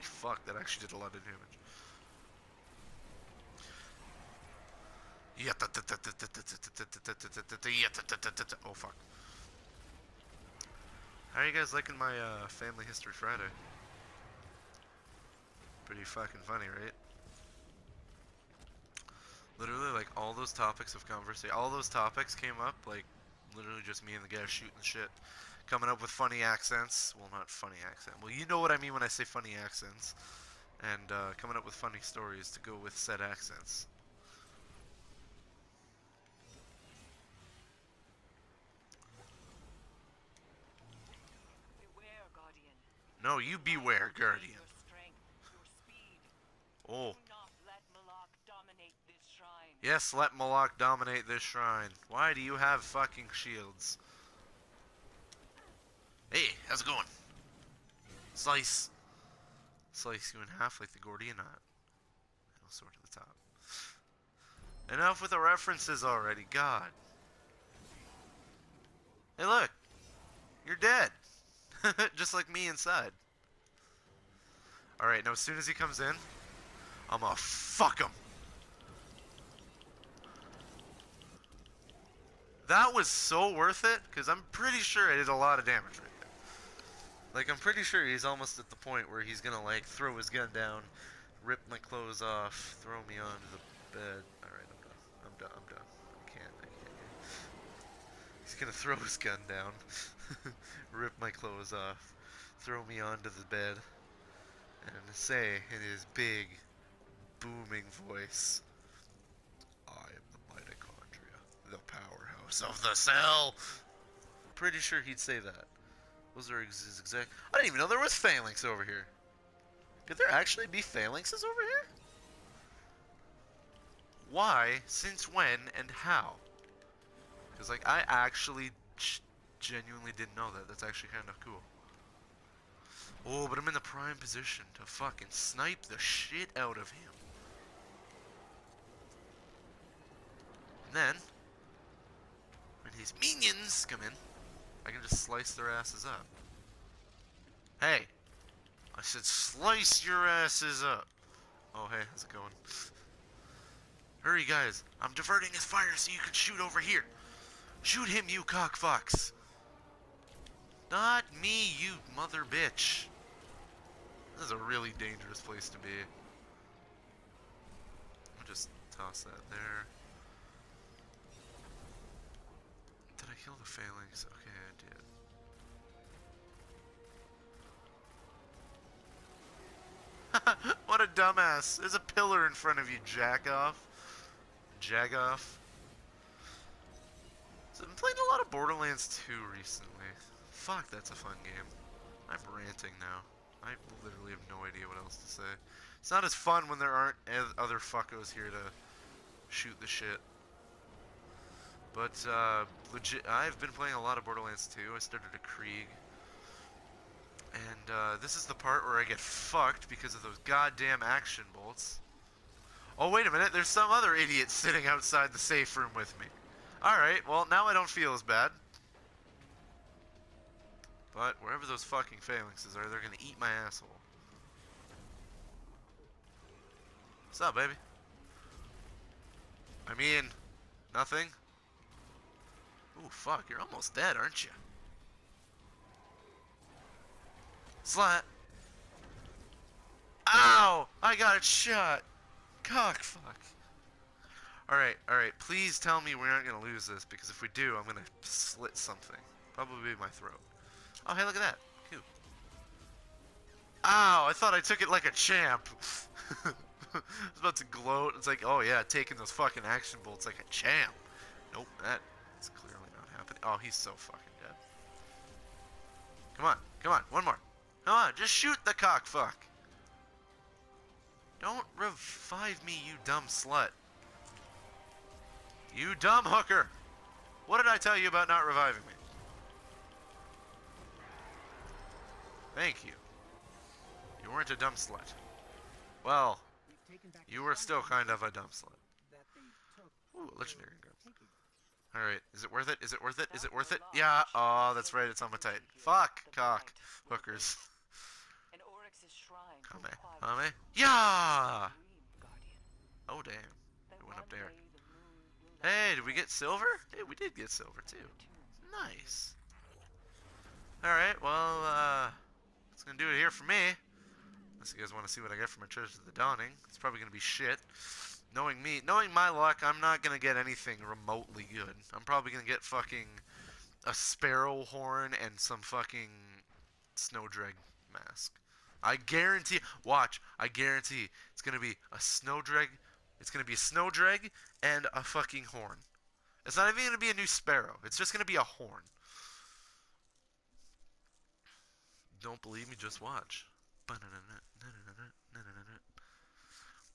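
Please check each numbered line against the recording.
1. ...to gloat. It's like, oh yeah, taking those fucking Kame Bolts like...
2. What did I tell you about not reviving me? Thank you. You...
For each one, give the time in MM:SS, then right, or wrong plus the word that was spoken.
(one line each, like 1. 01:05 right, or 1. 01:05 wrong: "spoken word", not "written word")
1. 04:17 wrong: "Axion", not "Kame"
2. 04:37 right.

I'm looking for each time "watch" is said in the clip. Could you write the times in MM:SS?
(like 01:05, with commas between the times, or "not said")
05:29, 05:43.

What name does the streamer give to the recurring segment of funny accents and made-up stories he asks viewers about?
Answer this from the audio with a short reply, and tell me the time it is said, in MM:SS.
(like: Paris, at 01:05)
Family History Friday, at 00:12.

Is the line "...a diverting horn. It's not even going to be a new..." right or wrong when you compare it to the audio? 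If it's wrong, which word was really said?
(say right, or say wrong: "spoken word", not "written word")
wrong: "fucking", not "diverting".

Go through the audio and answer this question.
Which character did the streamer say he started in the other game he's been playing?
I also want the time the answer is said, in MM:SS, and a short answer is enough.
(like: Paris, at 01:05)
Krieg, at 03:25.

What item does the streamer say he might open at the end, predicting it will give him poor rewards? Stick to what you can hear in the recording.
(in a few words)
Treasure of the Dawning.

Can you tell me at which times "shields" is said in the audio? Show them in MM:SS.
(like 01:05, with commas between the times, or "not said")
00:53.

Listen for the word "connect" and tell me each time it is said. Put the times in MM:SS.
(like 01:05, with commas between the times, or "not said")
not said.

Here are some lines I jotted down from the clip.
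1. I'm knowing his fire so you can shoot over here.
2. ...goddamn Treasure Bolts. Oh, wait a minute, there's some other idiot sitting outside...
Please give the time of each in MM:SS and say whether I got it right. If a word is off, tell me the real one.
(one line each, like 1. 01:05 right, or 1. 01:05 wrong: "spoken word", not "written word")
1. 02:34 wrong: "diverting", not "knowing"
2. 03:30 wrong: "Axion", not "Treasure".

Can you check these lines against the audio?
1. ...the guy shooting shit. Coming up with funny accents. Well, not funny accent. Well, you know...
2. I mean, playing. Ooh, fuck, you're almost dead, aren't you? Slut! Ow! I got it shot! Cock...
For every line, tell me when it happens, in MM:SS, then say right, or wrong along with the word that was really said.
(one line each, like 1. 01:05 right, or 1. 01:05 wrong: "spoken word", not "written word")
1. 00:24 right
2. 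03:49 wrong: "nothing", not "playing".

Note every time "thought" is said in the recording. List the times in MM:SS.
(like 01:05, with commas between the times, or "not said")
04:14.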